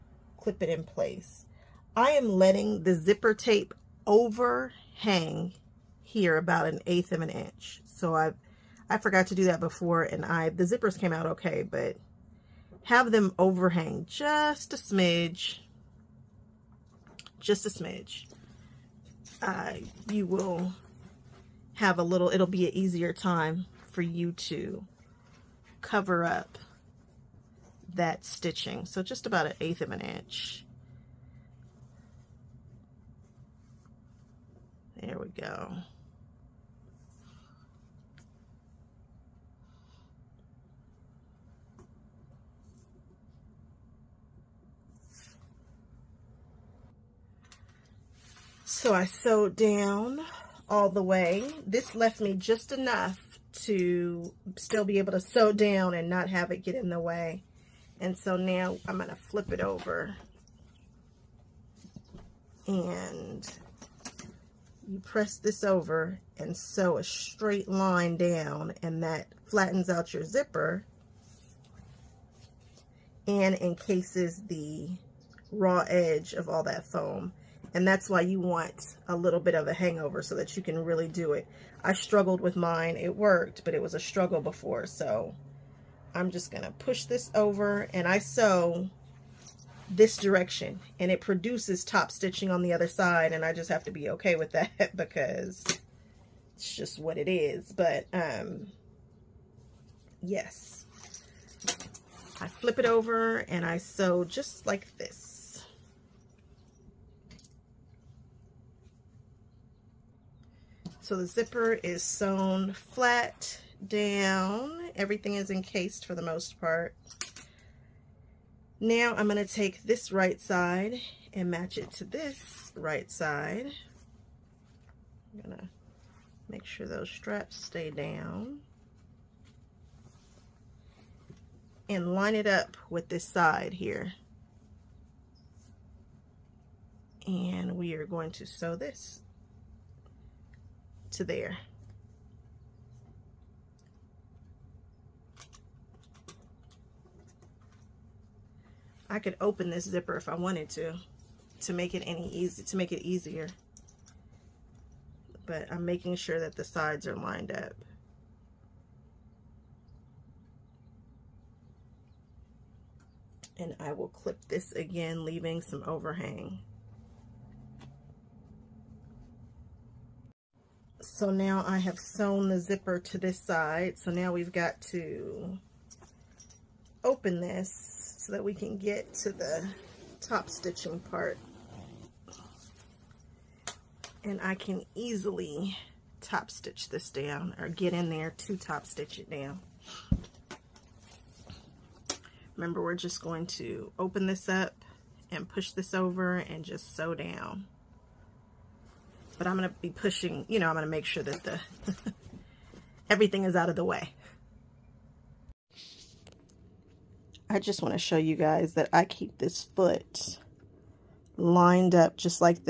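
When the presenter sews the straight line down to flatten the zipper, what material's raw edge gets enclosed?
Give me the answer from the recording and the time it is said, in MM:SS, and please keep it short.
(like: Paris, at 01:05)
foam, at 01:16.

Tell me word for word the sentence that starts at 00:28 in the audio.
So just about an eighth of an inch.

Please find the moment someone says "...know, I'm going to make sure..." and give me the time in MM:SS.
03:20.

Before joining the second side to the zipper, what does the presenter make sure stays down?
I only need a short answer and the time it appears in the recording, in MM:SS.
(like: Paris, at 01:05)
straps, at 02:07.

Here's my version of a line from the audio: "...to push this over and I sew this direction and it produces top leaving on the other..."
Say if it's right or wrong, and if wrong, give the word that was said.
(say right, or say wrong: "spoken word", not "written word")
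wrong: "stitching", not "leaving".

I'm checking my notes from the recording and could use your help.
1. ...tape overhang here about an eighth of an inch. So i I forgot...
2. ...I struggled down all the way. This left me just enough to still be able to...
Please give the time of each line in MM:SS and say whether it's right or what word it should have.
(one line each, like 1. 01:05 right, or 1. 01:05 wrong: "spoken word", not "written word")
1. 00:03 right
2. 00:48 wrong: "sewed", not "struggled".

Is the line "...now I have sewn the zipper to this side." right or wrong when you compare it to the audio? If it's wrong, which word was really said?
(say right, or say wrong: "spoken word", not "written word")
right.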